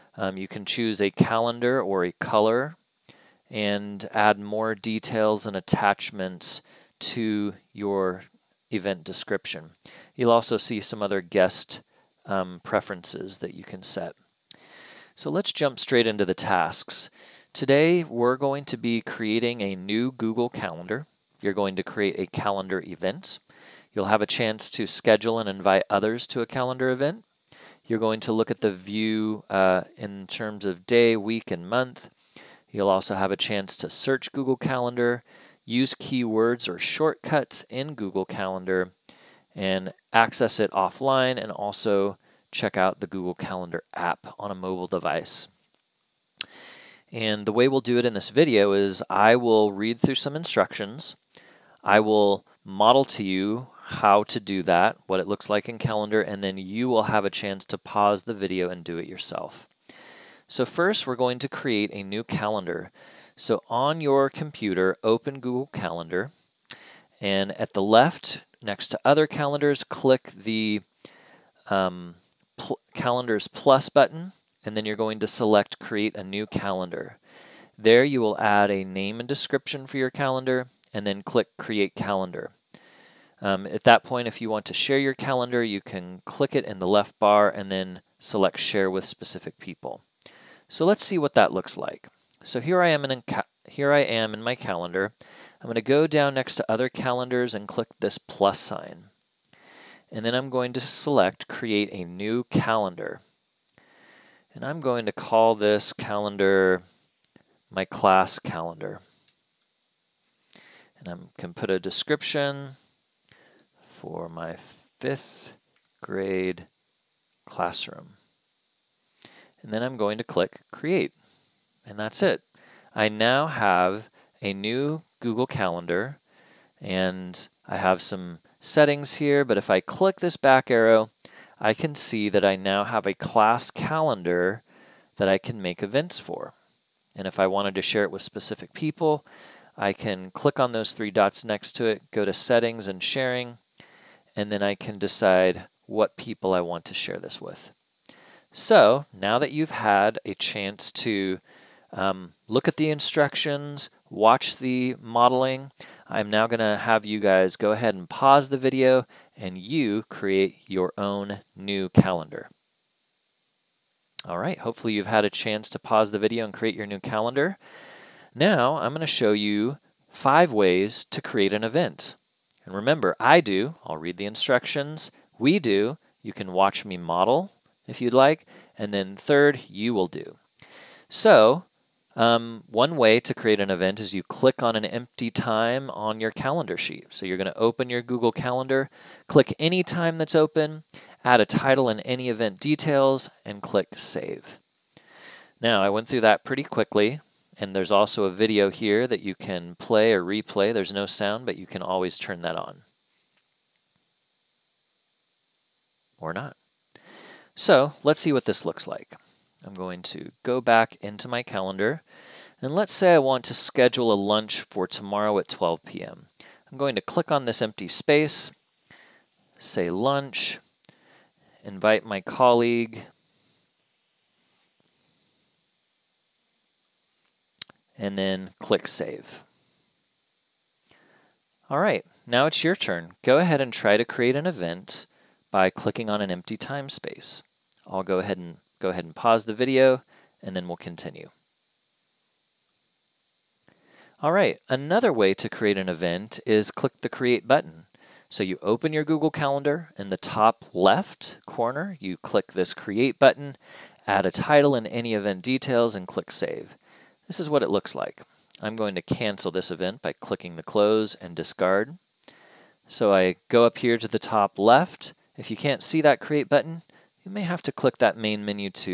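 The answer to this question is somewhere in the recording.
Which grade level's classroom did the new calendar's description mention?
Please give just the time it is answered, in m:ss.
1:54.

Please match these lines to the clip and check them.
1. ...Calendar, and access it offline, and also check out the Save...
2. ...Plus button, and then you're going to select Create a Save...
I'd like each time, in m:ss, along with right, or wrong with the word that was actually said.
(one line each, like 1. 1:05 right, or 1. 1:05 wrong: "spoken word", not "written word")
1. 0:38 wrong: "Google", not "Save"
2. 1:13 wrong: "New", not "Save".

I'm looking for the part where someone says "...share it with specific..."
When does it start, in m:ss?
2:17.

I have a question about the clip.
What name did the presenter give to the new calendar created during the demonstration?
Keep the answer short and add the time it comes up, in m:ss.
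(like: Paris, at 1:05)
my class calendar, at 1:47.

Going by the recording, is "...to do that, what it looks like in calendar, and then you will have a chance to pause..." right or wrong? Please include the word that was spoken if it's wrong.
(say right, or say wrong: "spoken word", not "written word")
right.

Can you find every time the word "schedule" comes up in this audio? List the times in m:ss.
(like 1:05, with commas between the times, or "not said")
0:24, 3:33.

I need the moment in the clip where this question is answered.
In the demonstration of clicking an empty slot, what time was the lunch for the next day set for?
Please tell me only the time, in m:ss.
3:35.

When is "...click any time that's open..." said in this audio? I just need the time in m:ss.
3:09.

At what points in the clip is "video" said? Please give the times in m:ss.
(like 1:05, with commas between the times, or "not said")
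0:48, 0:58, 2:38, 2:46, 3:18, 3:59.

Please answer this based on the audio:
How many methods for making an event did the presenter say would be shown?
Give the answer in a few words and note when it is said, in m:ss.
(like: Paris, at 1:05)
5, at 2:50.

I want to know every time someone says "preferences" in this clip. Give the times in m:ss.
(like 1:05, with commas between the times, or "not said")
0:12.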